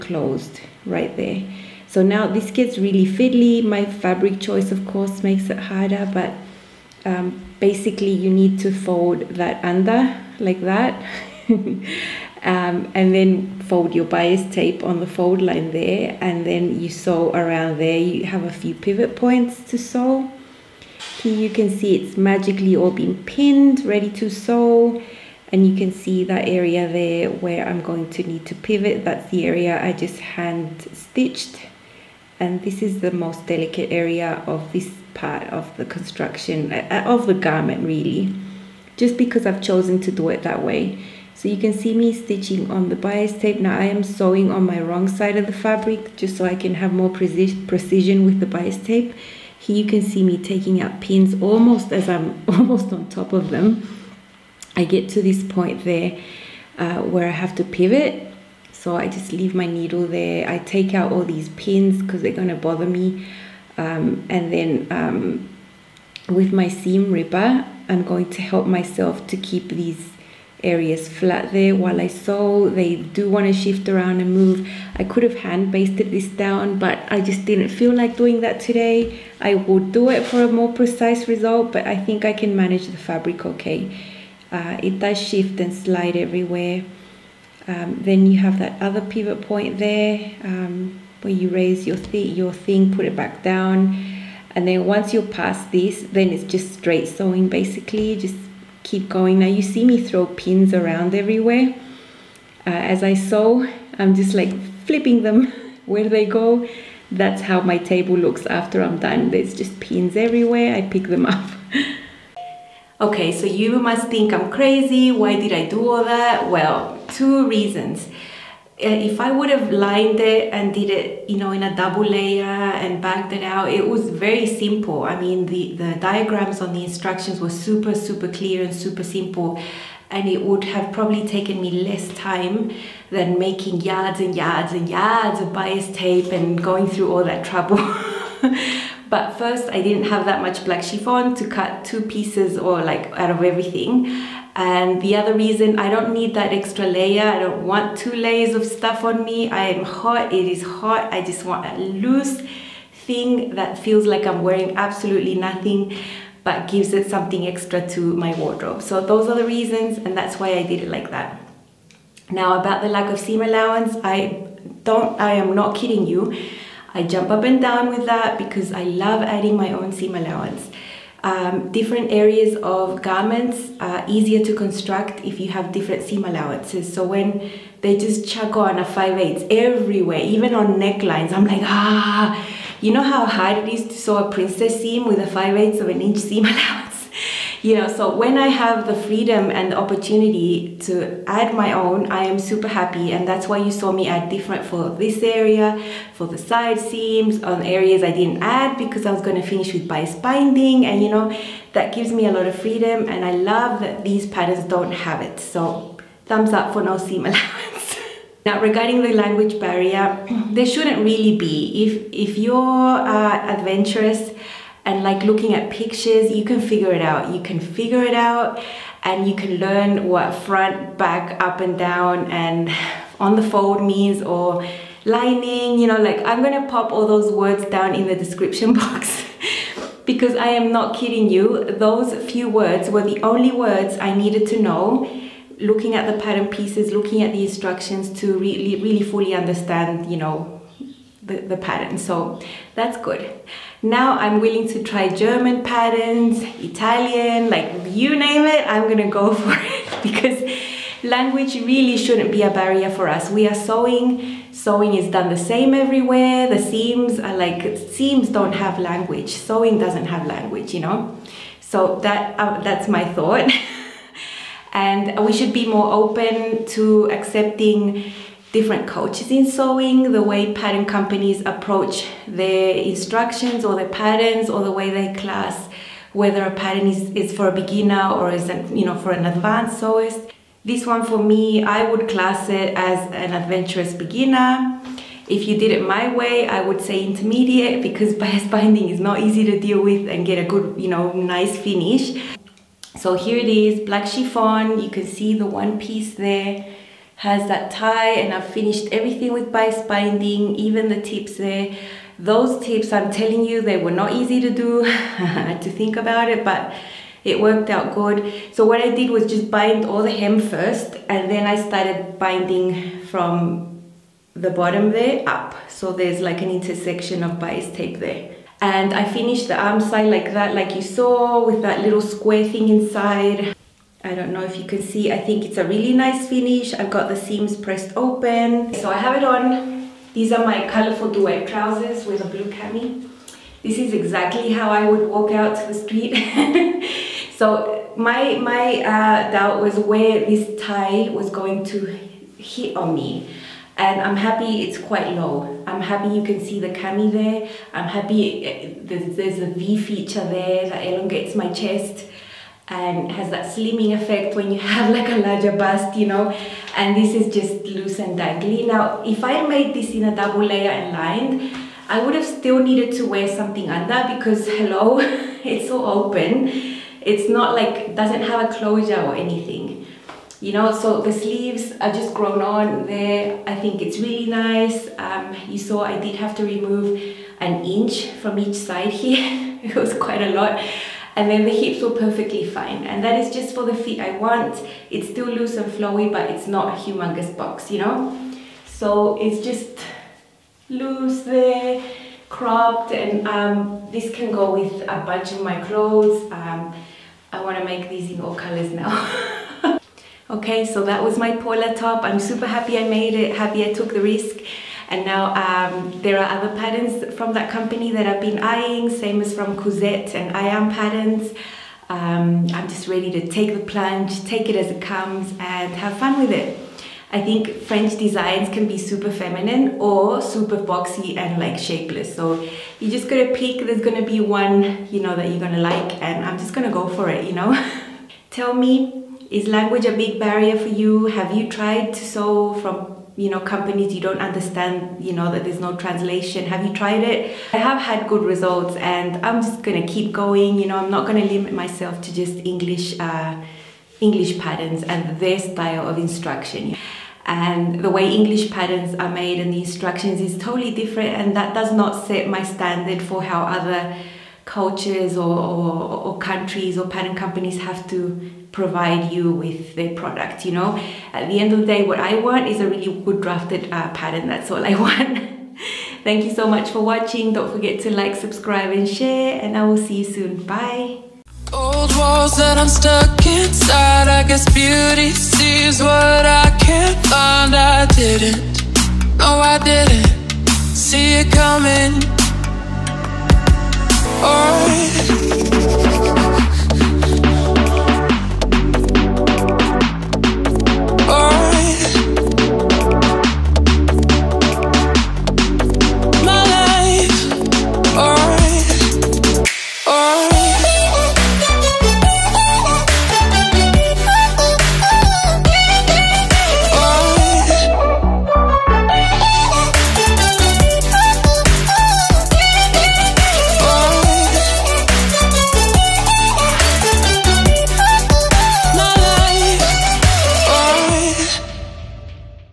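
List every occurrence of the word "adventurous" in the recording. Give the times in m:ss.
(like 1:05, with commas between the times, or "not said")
3:33, 4:43.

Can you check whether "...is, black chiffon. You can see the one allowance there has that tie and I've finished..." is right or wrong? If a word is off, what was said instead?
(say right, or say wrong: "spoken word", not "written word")
wrong: "piece", not "allowance".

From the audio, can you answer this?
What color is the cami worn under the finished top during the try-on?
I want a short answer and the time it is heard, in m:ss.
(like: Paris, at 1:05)
Blue, at 5:32.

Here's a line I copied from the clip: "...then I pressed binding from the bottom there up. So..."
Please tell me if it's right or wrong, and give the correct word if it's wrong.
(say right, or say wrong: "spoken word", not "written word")
wrong: "started", not "pressed".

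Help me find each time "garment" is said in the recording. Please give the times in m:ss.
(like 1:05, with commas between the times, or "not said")
0:37, 2:53.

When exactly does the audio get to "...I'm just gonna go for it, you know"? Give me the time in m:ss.
7:06.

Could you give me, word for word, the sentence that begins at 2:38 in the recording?
So those are the reasons and that's why I did it like that.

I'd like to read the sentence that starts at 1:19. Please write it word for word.
I will do it for a more precise result, but I think I can manage the fabric okay.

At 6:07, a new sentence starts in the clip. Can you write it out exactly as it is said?
It's not like, doesn't have a closure or anything.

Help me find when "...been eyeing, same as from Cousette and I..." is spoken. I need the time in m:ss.
6:48.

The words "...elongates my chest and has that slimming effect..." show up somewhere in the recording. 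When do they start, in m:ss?
5:50.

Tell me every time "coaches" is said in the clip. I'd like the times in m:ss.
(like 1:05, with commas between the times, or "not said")
4:28, 7:34.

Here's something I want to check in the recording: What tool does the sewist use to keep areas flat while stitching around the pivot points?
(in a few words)
Seam ripper.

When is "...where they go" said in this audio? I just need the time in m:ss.
1:45.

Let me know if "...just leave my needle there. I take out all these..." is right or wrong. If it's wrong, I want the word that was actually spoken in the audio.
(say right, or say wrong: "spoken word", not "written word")
right.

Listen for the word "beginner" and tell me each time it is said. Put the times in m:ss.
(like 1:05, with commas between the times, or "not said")
4:37, 4:43.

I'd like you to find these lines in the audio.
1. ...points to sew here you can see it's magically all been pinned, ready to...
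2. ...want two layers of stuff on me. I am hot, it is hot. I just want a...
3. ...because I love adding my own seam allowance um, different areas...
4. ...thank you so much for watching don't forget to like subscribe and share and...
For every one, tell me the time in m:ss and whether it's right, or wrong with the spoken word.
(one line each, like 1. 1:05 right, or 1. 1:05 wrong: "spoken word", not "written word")
1. 0:19 right
2. 2:27 right
3. 2:48 right
4. 7:46 right.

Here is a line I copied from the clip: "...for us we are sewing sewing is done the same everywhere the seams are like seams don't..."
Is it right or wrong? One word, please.
right.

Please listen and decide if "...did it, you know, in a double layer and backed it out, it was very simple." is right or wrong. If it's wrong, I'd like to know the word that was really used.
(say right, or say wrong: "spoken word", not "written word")
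right.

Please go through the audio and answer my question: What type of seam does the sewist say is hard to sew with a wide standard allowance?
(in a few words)
Princess seam.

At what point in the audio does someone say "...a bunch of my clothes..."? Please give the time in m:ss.
6:34.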